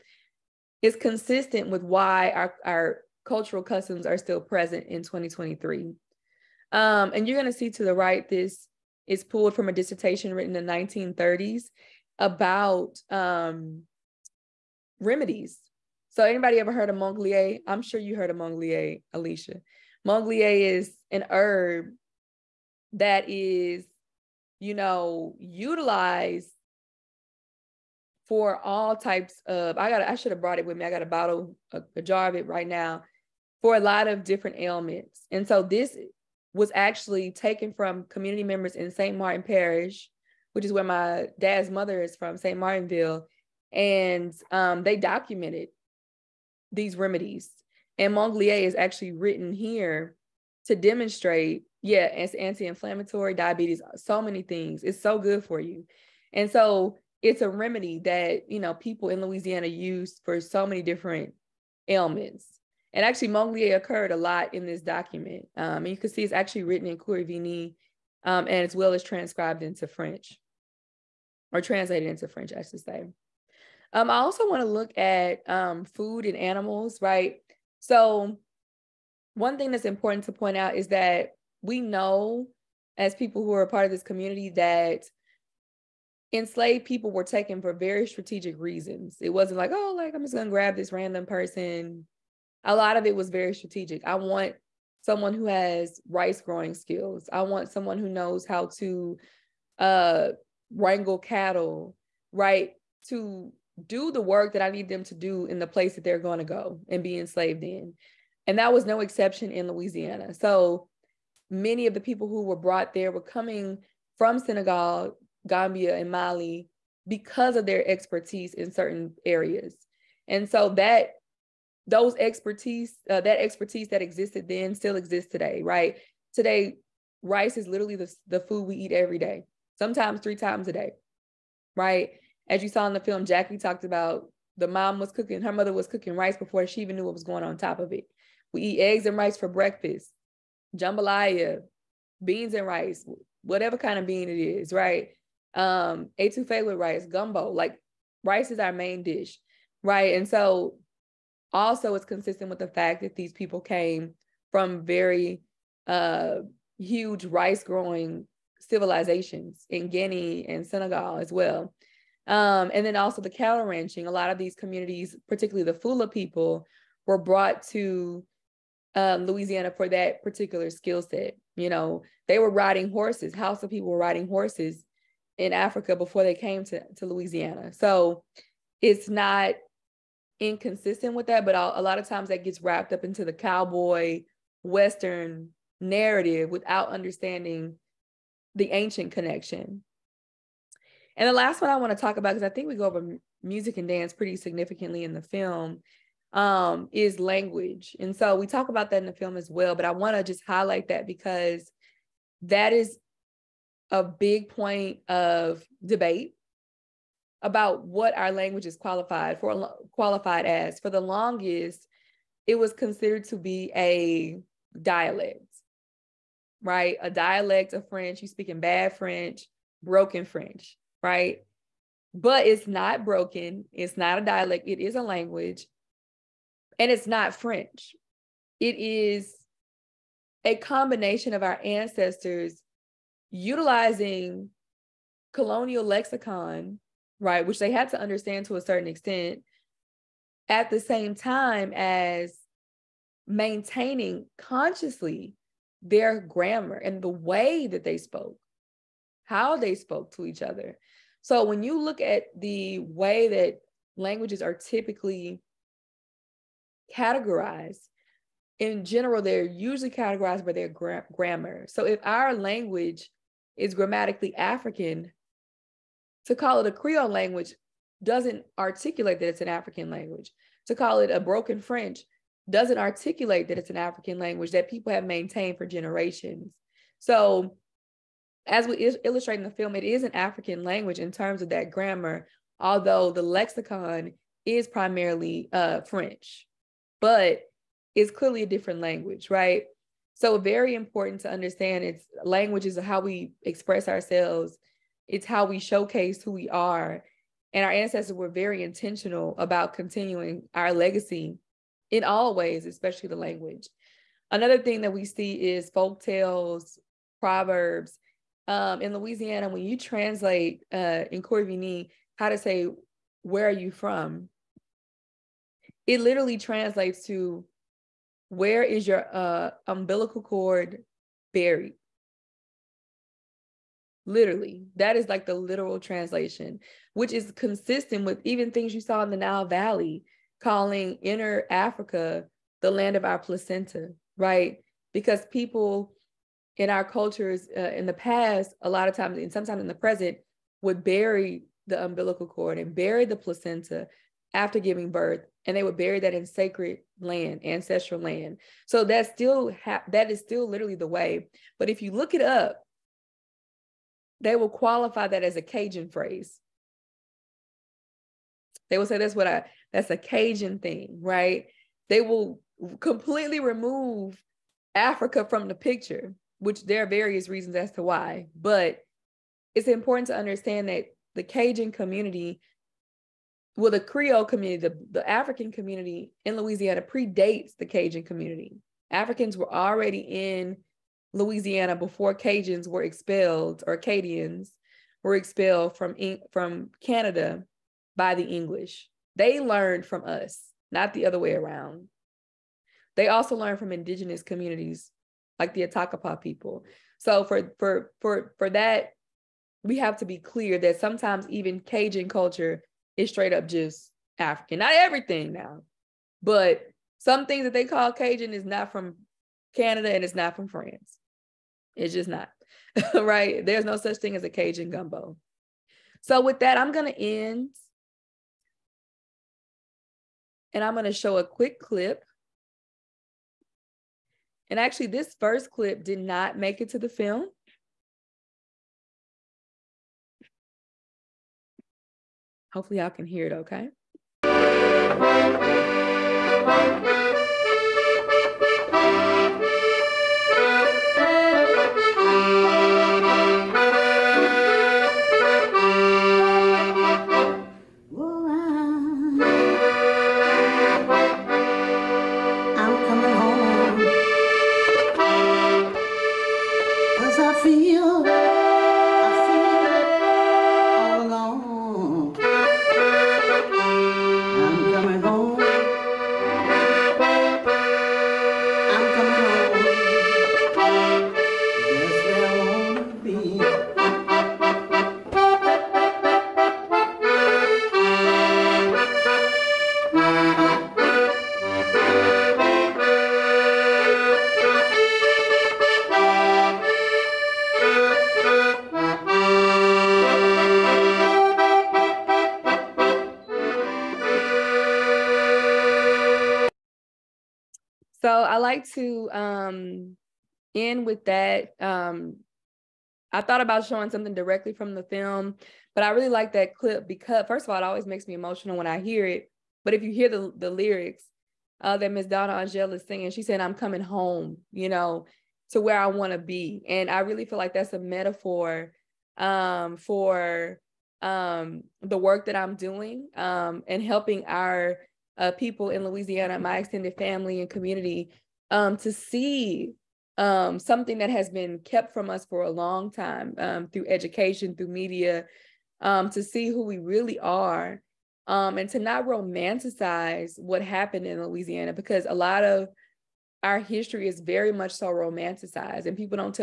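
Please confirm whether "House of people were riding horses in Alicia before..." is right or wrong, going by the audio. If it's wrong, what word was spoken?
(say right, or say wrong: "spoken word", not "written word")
wrong: "Africa", not "Alicia".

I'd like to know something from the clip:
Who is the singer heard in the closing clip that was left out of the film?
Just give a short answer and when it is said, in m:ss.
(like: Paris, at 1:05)
Donna Angel, at 8:31.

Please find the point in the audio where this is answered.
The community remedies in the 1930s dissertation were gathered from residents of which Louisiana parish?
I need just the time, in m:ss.
0:38.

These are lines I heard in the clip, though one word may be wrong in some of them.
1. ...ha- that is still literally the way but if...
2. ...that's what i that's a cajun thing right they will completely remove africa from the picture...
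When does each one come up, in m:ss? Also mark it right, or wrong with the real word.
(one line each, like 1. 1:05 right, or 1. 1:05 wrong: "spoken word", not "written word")
1. 5:49 right
2. 5:58 right.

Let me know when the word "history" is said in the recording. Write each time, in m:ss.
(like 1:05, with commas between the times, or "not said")
9:03.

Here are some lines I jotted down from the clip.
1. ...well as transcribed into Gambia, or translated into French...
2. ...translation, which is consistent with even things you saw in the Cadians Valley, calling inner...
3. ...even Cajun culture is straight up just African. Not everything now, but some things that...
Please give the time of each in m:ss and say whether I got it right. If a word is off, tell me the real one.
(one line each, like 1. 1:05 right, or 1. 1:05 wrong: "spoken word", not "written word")
1. 1:08 wrong: "French", not "Gambia"
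2. 5:25 wrong: "Nile", not "Cadians"
3. 6:41 right.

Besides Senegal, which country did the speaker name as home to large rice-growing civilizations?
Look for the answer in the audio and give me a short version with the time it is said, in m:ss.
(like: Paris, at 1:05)
Guinea, at 2:39.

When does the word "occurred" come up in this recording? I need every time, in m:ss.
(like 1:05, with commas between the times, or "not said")
1:03.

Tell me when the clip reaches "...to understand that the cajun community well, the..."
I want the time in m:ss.
6:10.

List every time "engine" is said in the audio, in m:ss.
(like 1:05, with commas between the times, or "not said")
not said.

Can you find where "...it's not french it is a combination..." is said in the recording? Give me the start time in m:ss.
3:46.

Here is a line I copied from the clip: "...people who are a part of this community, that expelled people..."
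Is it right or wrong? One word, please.
wrong.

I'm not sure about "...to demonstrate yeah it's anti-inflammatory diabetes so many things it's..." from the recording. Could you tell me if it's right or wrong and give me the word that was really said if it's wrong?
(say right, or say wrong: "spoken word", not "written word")
right.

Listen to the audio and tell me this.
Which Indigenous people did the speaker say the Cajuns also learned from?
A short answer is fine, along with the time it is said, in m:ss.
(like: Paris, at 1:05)
Atakapa, at 6:35.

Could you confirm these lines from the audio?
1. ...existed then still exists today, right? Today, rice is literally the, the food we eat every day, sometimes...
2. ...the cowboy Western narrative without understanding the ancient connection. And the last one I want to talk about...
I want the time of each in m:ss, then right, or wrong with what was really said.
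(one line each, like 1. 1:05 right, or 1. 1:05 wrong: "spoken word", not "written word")
1. 2:04 right
2. 3:03 right.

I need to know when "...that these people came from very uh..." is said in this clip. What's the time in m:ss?
2:33.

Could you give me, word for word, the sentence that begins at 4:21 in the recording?
So if our language is grammatically African, to call it a Creole language doesn't articulate that it's an African language.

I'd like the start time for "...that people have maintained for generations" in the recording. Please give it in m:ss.
4:34.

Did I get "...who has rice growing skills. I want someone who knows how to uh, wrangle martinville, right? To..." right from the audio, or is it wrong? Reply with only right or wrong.
wrong.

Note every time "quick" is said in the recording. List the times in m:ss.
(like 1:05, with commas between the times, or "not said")
7:01.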